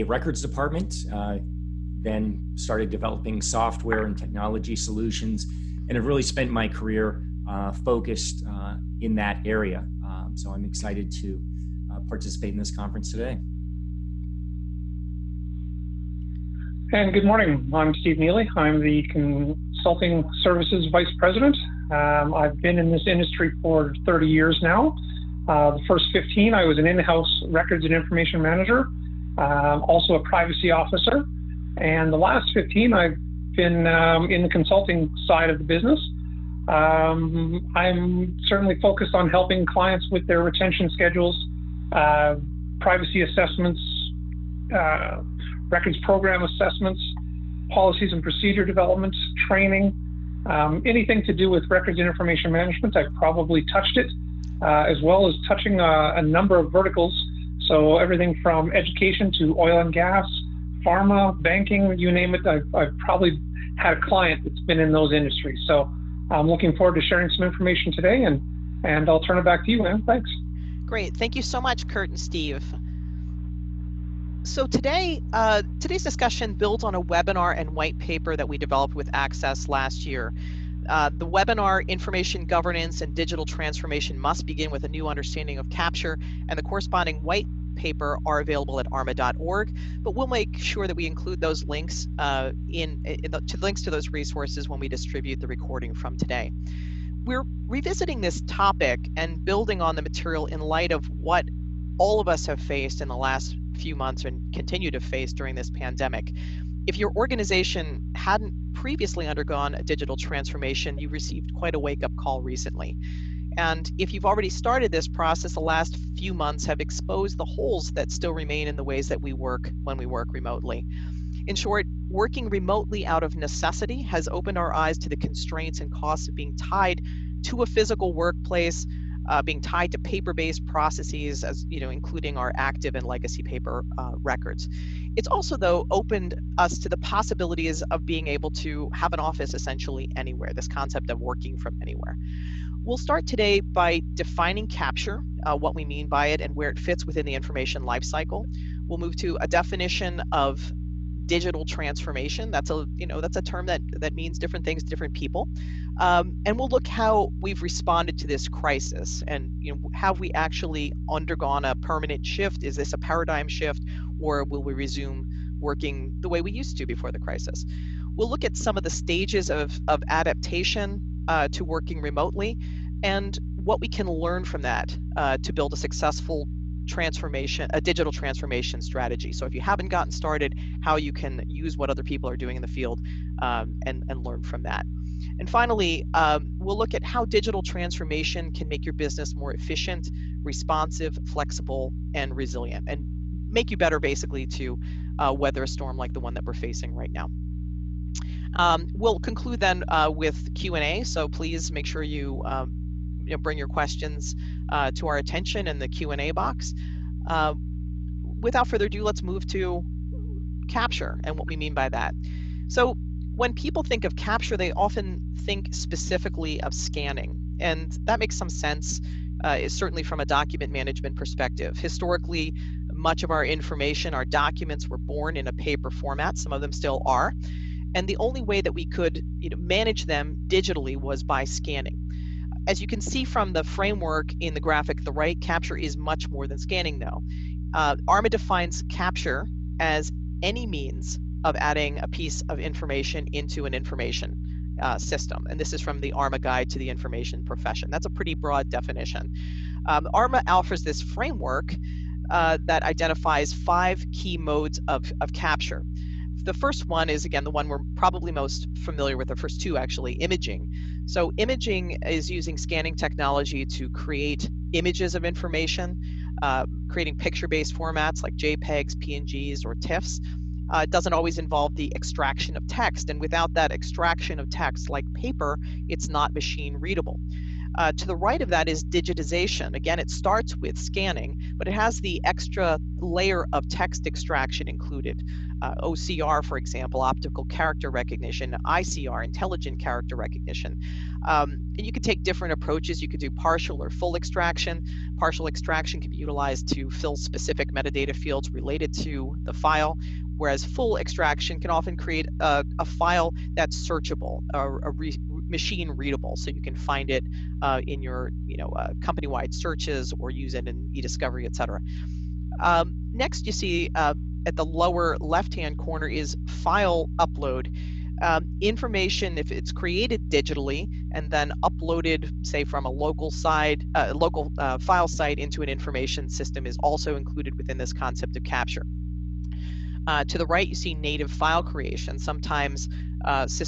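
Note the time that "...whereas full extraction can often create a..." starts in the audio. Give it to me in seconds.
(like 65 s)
300 s.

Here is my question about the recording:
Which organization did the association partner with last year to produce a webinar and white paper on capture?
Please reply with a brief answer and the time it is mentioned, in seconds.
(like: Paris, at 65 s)
Access, at 79 s.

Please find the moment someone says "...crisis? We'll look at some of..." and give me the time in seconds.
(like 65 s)
167 s.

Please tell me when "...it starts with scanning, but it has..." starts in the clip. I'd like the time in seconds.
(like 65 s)
279 s.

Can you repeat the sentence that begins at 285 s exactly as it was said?
Uh, OCR, for example, optical character recognition, ICR, intelligent character recognition.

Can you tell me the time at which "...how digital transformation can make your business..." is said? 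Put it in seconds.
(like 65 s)
187 s.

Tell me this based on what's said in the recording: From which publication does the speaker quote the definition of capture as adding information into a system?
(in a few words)
ARMA Guide to the Information Profession.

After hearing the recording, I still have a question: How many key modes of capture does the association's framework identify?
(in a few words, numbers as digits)
5.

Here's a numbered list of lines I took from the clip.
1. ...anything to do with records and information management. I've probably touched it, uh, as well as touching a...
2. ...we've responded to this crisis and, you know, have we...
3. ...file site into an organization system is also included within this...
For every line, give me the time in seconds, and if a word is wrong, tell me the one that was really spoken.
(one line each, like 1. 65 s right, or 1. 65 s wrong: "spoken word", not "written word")
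1. 50 s right
2. 157 s right
3. 324 s wrong: "information", not "organization".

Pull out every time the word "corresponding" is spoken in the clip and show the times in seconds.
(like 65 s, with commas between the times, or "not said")
86 s.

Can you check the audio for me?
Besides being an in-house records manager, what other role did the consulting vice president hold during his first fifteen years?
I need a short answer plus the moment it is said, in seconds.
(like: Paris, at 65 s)
privacy officer, at 30 s.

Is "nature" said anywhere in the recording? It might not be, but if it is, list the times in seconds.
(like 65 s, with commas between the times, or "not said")
not said.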